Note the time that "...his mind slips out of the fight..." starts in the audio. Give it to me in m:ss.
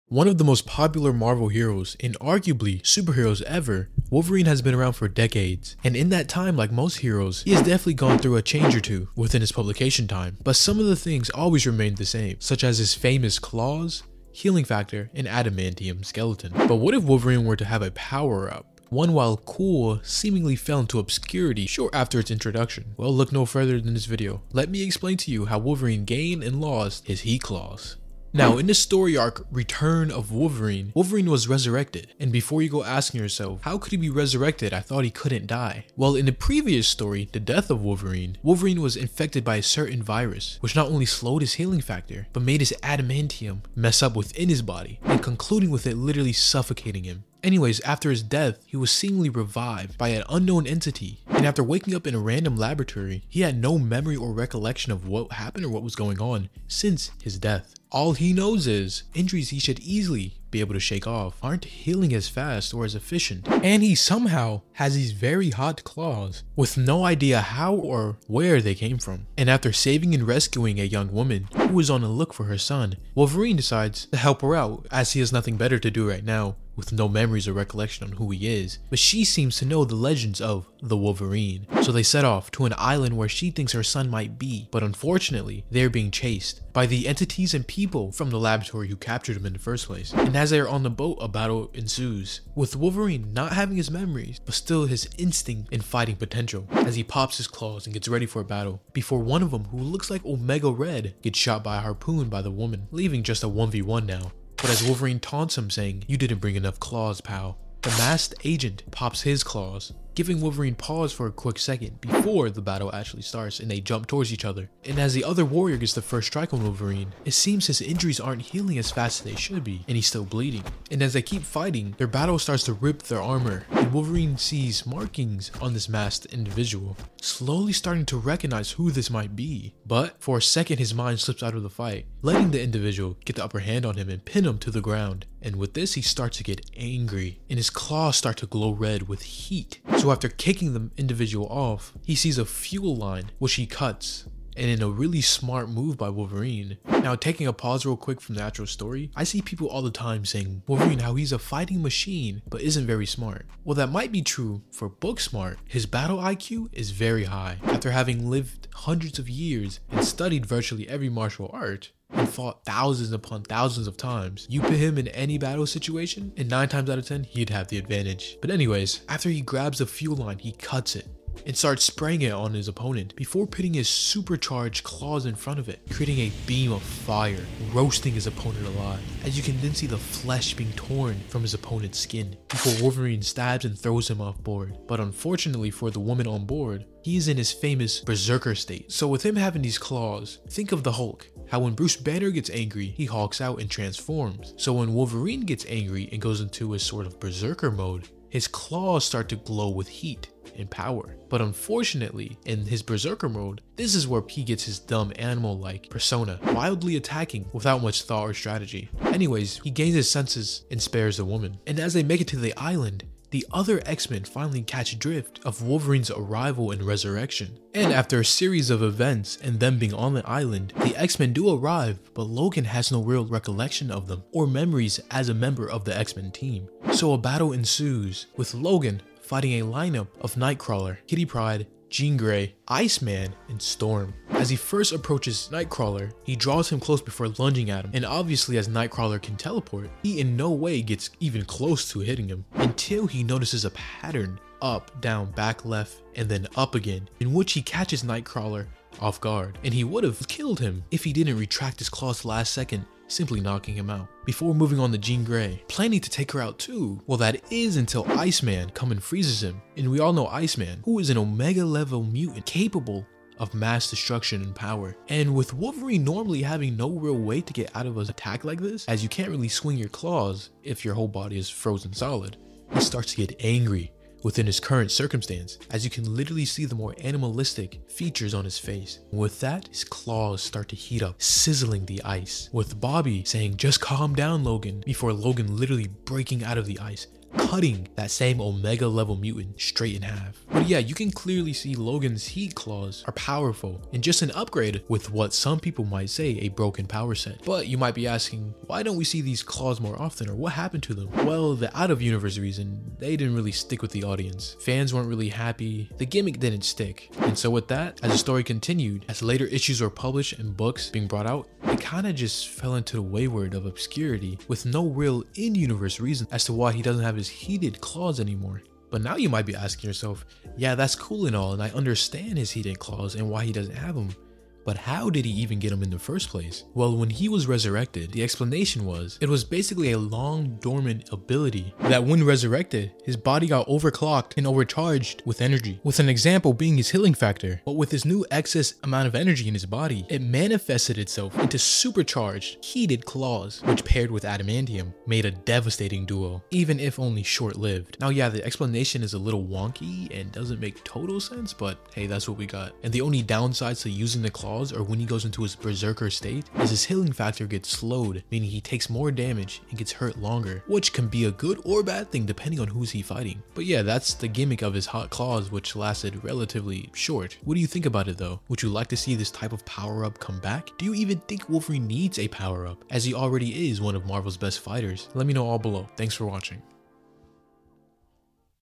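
2:10.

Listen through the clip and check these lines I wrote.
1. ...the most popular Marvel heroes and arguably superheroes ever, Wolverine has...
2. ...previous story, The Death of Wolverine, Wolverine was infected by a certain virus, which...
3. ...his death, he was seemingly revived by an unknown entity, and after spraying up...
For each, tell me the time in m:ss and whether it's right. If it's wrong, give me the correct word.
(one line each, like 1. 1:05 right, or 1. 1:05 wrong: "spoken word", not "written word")
1. 0:00 right
2. 0:36 right
3. 0:48 wrong: "waking", not "spraying".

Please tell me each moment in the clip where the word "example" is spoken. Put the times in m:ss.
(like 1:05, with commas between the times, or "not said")
5:36.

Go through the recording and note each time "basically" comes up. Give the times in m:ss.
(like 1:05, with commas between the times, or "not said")
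5:29.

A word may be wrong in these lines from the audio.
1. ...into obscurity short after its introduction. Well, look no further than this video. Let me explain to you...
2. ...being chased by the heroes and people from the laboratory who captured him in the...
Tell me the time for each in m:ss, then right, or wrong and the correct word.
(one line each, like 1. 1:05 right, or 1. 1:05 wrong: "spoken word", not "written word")
1. 0:20 right
2. 1:25 wrong: "entities", not "heroes".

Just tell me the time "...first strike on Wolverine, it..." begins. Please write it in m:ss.
1:56.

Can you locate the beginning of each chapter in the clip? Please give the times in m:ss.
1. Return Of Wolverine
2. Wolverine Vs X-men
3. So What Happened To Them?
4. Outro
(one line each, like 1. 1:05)
1. 0:28
2. 3:45
3. 4:57
4. 6:03.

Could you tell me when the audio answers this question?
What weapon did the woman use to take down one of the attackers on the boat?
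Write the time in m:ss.
1:41.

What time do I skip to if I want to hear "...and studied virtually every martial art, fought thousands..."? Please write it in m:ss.
2:39.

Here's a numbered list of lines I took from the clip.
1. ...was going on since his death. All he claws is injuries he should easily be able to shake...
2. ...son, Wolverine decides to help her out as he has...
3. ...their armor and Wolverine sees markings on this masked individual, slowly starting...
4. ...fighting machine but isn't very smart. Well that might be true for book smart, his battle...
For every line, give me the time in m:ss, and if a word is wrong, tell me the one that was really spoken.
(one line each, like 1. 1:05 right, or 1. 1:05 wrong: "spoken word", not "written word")
1. 0:55 wrong: "knows", not "claws"
2. 1:12 right
3. 2:03 right
4. 2:31 right.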